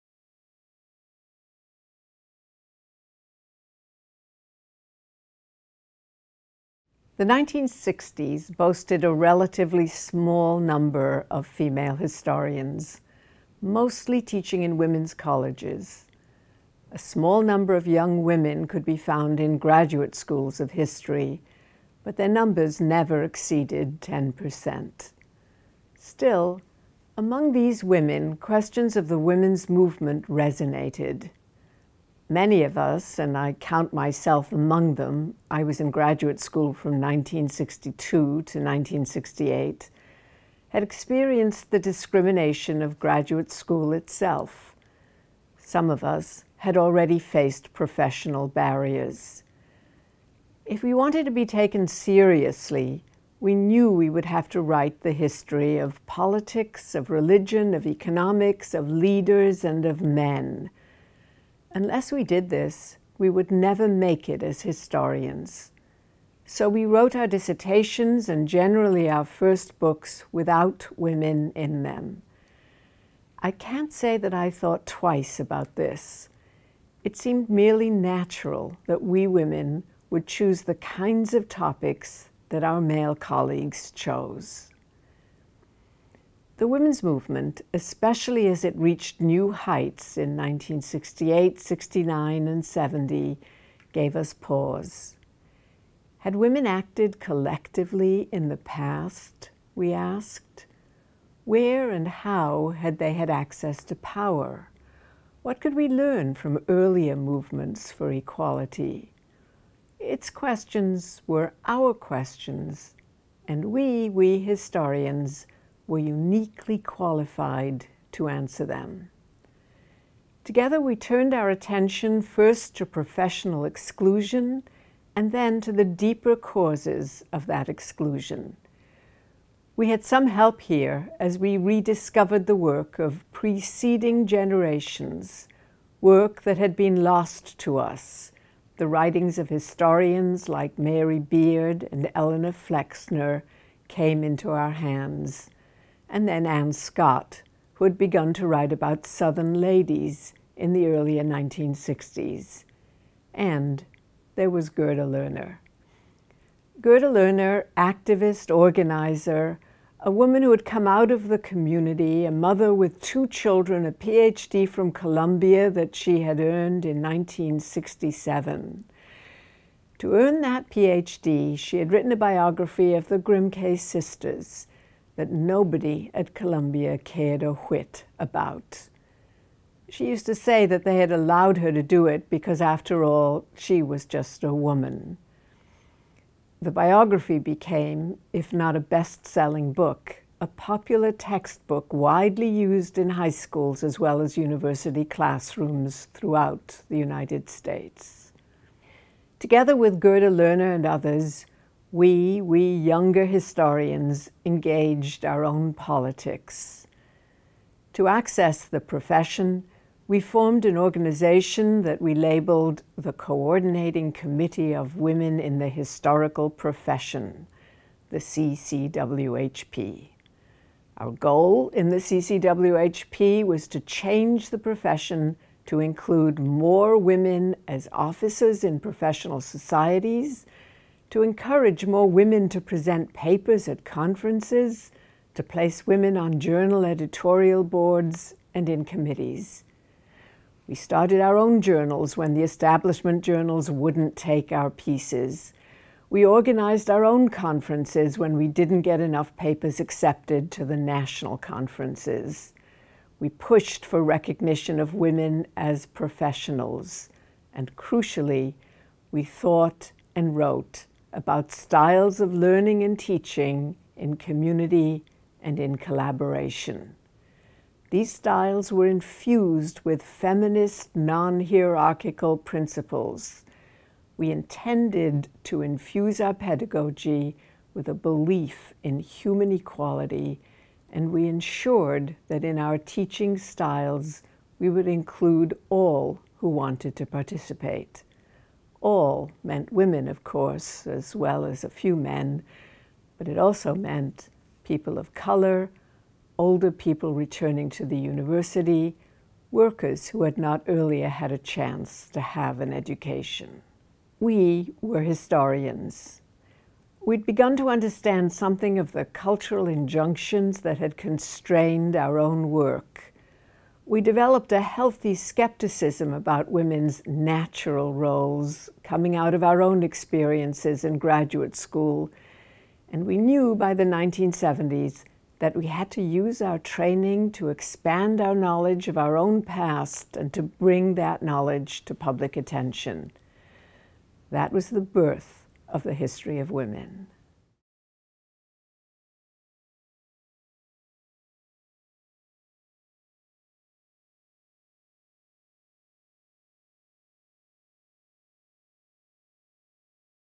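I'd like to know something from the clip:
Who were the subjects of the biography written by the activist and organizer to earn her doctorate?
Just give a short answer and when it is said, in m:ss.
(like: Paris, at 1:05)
The Grimke sisters, at 2:53.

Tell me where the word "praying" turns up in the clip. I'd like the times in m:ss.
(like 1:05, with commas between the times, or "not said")
not said.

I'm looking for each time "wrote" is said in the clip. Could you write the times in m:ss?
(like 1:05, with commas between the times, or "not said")
1:06, 4:20.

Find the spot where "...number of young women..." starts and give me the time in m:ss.
0:17.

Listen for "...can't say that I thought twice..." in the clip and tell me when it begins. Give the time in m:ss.
1:13.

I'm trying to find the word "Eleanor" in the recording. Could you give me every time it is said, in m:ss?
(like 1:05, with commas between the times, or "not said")
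2:22.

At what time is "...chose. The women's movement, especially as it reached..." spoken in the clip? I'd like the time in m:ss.
1:23.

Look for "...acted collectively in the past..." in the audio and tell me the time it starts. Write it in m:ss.
1:36.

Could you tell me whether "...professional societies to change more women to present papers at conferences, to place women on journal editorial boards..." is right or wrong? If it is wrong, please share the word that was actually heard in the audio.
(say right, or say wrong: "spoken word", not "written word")
wrong: "encourage", not "change".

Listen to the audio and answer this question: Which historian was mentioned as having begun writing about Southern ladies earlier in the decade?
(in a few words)
Anne Scott.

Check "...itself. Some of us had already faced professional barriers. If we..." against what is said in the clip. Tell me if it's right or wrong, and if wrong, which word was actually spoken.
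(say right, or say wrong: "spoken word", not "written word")
right.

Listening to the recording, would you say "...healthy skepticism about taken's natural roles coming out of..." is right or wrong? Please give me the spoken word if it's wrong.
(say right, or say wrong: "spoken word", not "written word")
wrong: "women", not "taken".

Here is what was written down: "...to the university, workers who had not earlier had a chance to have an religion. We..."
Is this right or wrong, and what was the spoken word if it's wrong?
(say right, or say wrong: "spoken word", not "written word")
wrong: "education", not "religion".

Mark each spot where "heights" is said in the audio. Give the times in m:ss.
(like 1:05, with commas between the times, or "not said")
1:29.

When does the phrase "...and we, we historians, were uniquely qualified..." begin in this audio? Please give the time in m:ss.
1:53.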